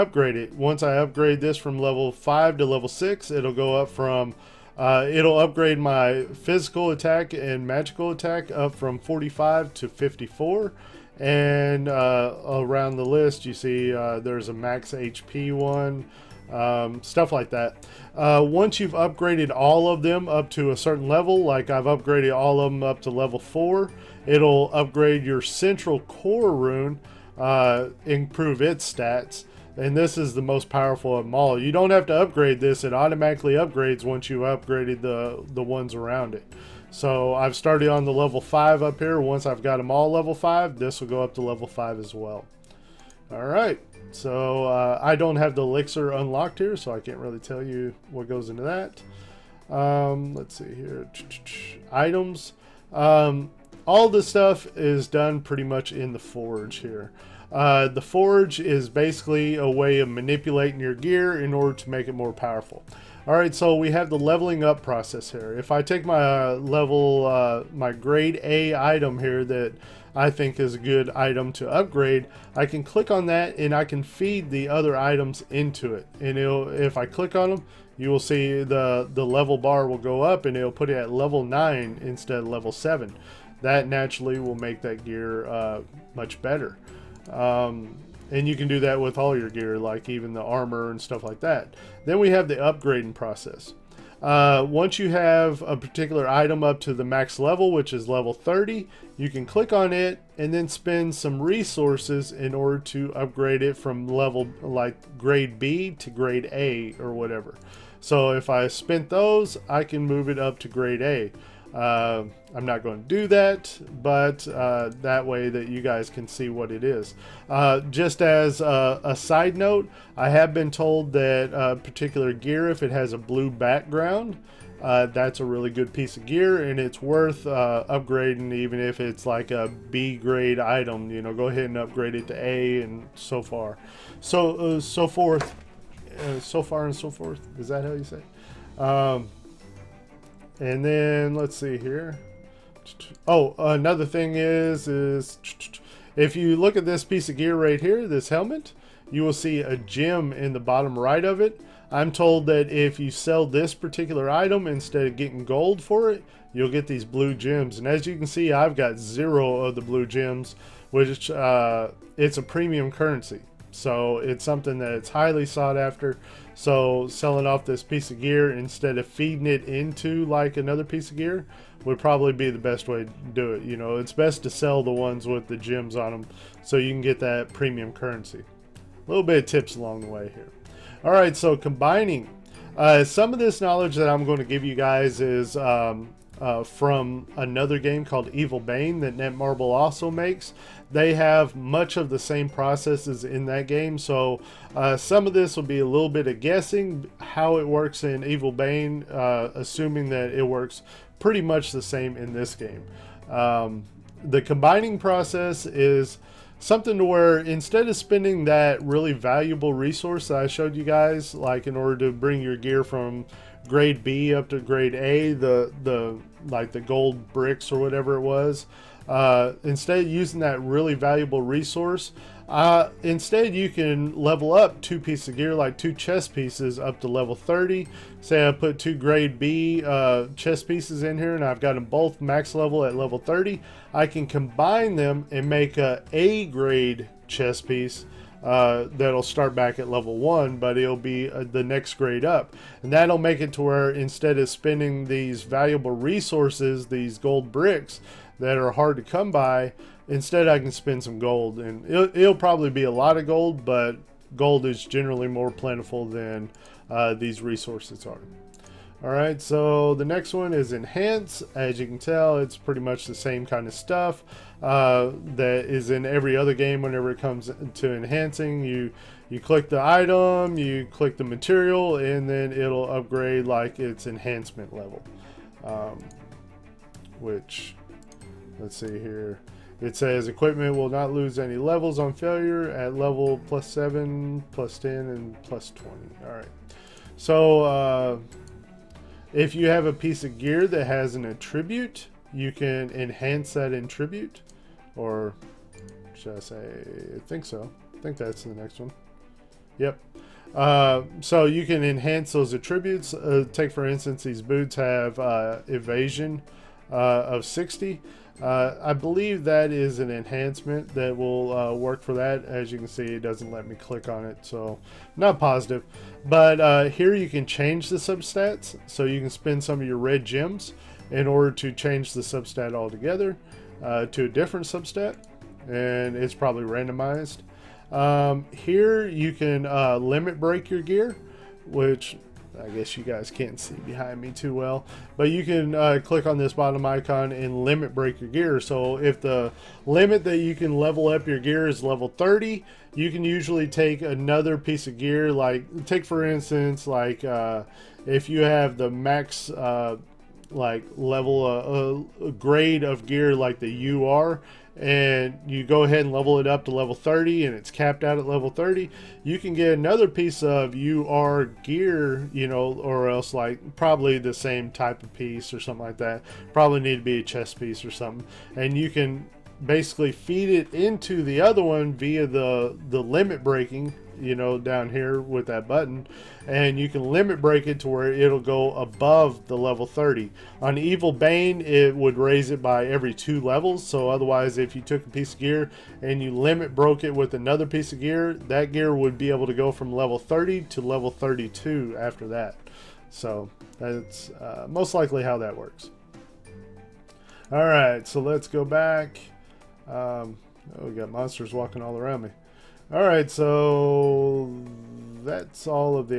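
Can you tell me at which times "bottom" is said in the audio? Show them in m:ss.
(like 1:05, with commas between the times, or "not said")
2:30, 5:36.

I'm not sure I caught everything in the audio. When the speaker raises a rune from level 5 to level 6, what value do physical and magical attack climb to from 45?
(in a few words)
54.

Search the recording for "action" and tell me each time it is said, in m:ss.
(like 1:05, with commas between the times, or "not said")
not said.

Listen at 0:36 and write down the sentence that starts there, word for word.
So I've started on the level 5 up here.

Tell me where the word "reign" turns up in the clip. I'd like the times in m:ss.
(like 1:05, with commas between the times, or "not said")
not said.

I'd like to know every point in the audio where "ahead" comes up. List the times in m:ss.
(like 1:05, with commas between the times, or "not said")
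2:11, 5:55.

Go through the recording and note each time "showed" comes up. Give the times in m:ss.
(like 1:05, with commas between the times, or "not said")
3:30.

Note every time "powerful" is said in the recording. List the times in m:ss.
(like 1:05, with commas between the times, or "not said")
0:30, 1:02.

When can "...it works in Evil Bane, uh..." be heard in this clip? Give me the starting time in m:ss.
3:17.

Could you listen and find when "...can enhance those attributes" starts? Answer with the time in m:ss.
5:01.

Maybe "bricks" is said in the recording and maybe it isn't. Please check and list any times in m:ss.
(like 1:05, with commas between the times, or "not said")
3:37, 4:07.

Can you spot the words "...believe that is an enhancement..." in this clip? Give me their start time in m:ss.
5:08.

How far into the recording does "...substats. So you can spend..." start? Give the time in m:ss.
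5:17.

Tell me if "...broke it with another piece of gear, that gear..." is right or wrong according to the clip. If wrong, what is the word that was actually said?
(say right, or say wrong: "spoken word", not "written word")
right.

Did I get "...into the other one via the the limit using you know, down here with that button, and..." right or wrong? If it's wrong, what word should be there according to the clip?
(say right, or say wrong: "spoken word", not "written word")
wrong: "breaking", not "using".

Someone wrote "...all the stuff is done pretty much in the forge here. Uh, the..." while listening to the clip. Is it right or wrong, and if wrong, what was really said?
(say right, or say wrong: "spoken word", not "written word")
right.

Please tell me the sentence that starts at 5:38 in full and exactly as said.
So if the limit that you can level up your gear is level 30, you can usually take another piece of gear.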